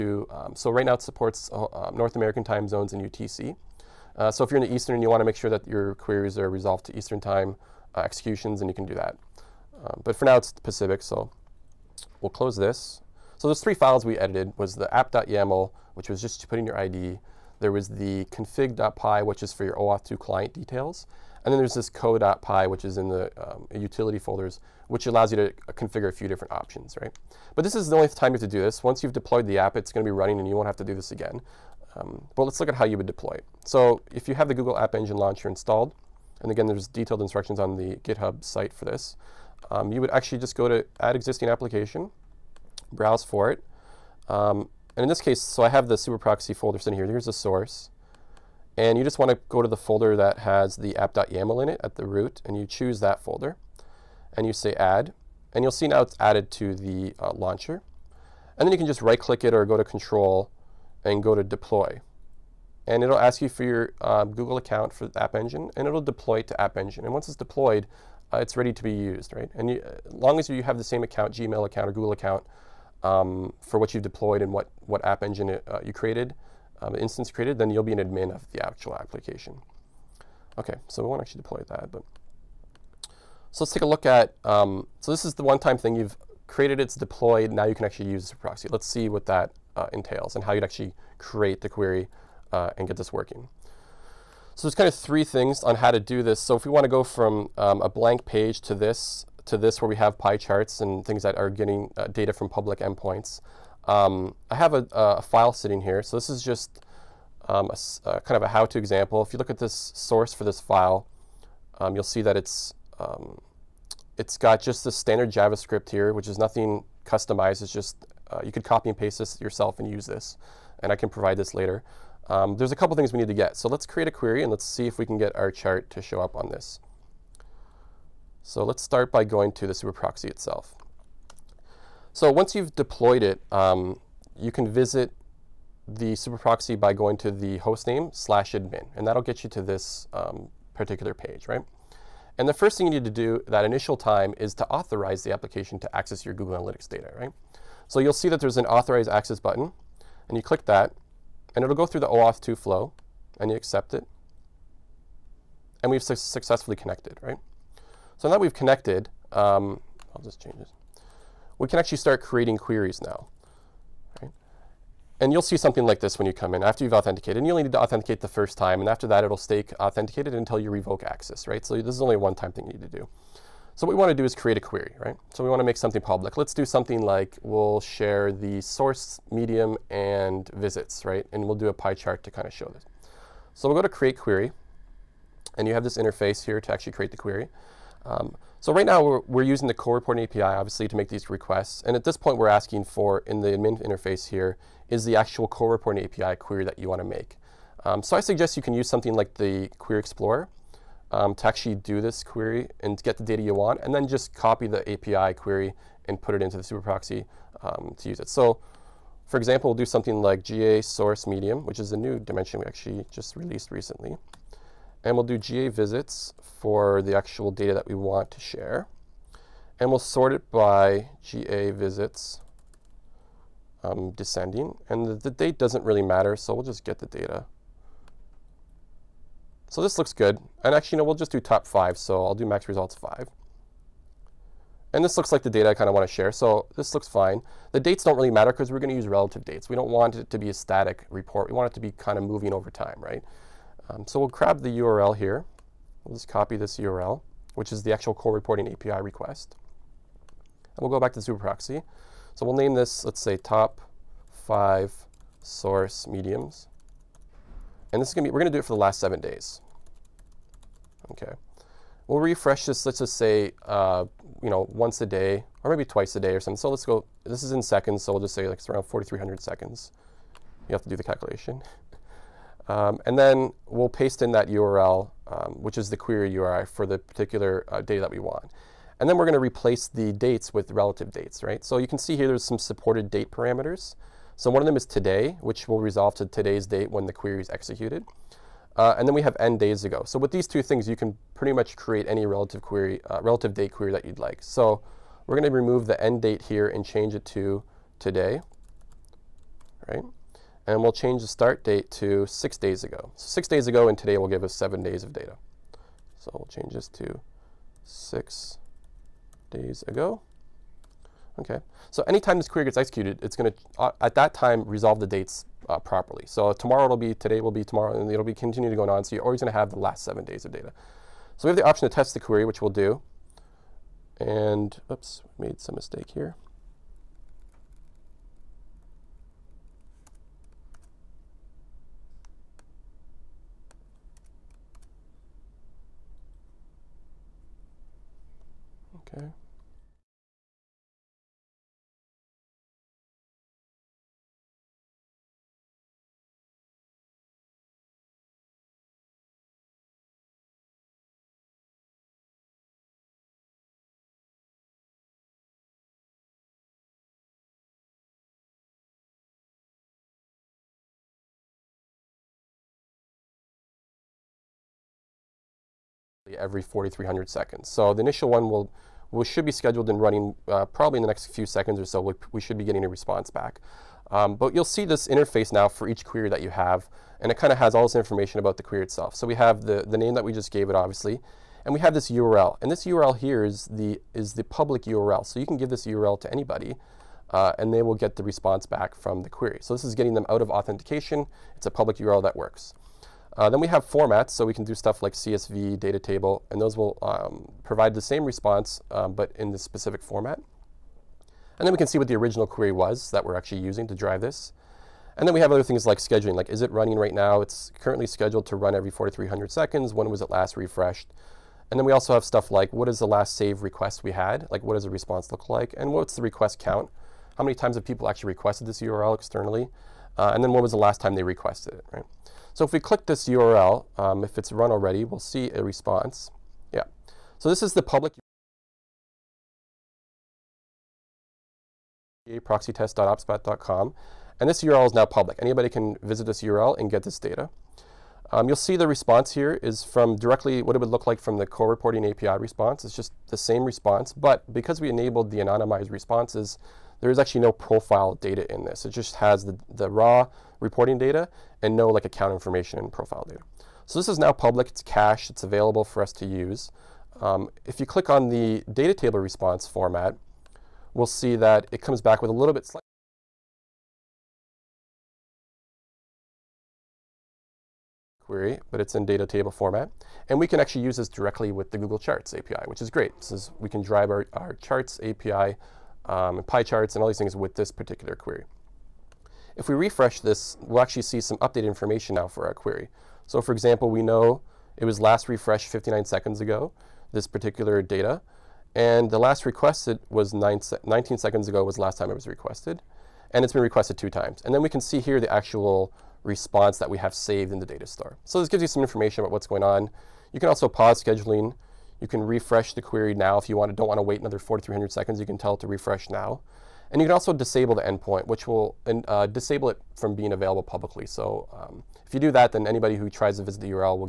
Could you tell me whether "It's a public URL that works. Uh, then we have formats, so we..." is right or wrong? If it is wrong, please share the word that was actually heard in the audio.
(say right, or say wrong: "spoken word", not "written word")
right.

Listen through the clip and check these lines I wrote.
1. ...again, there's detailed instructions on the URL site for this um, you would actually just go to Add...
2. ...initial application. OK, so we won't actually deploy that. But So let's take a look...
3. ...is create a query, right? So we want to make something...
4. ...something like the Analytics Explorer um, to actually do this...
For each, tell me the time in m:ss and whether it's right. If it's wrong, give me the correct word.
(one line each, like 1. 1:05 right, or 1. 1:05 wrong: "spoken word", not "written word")
1. 0:36 wrong: "GitHub", not "URL"
2. 1:18 wrong: "actual", not "initial"
3. 2:54 right
4. 3:18 wrong: "Query", not "Analytics".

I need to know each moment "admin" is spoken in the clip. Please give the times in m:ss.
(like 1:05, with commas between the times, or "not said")
1:17, 2:18, 3:13.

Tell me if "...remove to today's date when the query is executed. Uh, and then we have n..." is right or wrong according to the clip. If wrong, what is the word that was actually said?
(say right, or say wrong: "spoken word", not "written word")
wrong: "resolve", not "remove".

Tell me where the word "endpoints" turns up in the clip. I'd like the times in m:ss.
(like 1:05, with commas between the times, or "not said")
1:42, 8:27.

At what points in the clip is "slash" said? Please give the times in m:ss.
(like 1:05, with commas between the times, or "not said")
2:18.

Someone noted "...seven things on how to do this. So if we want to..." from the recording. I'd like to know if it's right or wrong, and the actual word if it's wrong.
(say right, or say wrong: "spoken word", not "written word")
wrong: "three", not "seven".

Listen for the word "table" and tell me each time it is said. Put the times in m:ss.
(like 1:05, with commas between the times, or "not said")
6:35, 7:38, 7:49.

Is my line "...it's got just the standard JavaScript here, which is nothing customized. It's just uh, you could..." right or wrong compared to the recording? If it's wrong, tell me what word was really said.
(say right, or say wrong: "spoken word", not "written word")
right.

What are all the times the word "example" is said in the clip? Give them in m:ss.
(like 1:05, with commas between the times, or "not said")
1:48, 3:29, 8:03.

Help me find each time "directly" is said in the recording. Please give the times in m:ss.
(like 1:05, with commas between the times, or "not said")
7:20, 7:51.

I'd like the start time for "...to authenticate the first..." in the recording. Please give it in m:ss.
2:47.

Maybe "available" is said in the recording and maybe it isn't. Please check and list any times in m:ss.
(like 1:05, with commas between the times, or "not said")
7:35, 8:30.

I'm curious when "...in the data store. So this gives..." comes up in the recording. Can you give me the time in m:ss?
8:17.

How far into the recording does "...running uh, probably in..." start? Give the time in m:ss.
6:10.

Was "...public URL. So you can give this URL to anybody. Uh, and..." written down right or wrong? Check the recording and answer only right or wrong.
right.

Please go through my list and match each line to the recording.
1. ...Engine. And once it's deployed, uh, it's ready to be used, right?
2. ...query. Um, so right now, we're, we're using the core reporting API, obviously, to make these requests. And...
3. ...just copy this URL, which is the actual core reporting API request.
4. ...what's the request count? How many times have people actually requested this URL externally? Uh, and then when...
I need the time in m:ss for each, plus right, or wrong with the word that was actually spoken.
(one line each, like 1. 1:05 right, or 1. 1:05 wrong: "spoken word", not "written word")
1. 1:06 right
2. 3:07 right
3. 4:06 right
4. 6:55 right.